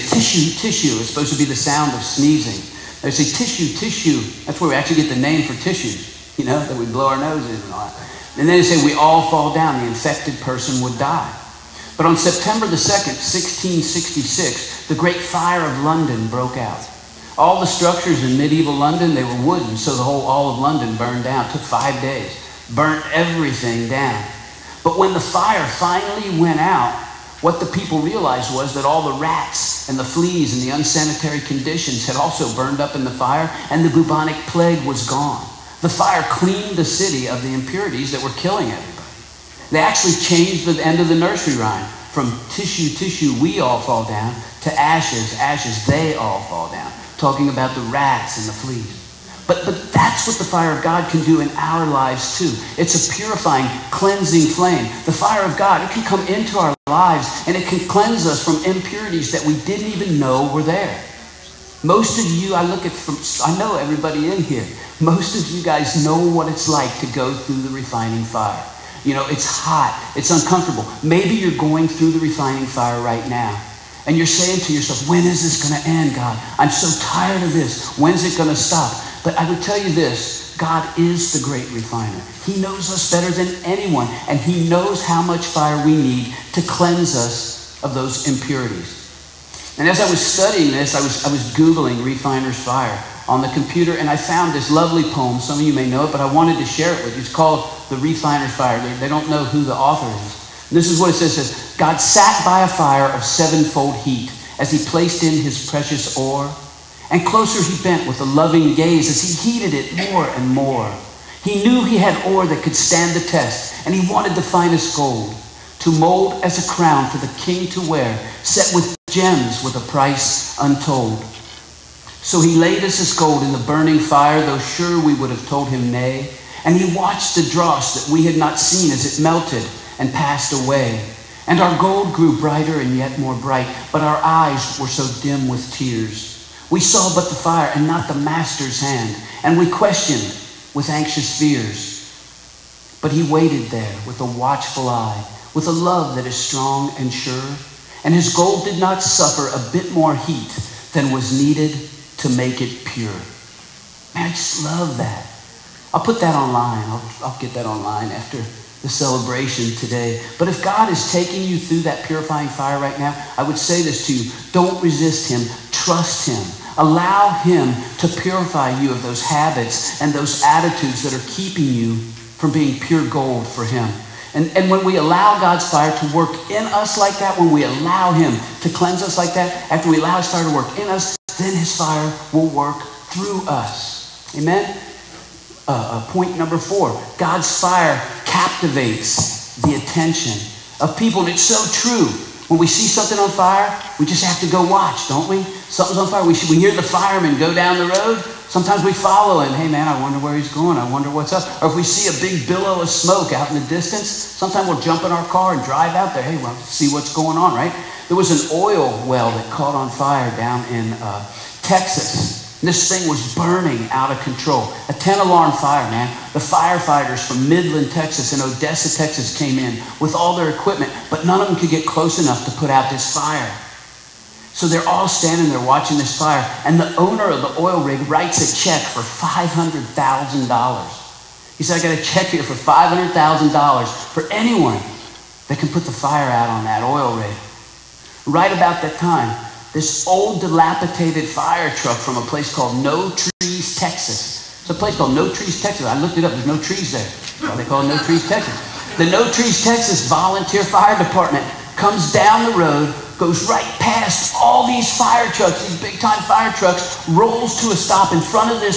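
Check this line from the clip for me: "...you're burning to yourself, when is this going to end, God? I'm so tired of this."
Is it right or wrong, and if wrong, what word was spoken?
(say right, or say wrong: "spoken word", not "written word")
wrong: "saying", not "burning".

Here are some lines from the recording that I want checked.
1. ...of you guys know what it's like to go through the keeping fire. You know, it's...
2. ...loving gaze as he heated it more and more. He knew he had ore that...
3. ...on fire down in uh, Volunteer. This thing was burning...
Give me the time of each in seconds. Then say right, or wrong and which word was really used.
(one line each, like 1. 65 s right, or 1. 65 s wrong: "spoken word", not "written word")
1. 65 s wrong: "refining", not "keeping"
2. 108 s right
3. 209 s wrong: "Texas", not "Volunteer".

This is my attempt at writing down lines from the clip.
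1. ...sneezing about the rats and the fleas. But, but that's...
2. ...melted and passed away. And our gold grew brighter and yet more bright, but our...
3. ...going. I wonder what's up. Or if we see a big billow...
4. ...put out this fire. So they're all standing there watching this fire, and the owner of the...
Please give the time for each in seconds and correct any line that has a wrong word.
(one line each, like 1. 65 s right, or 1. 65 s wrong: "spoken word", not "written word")
1. 47 s wrong: "talking", not "sneezing"
2. 129 s right
3. 200 s right
4. 222 s right.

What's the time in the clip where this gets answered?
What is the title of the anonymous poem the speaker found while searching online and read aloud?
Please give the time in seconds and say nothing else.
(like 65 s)
97 s.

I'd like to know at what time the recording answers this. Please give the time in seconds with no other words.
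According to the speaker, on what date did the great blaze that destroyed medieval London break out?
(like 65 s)
12 s.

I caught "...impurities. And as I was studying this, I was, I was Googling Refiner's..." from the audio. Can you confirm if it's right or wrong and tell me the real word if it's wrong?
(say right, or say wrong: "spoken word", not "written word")
right.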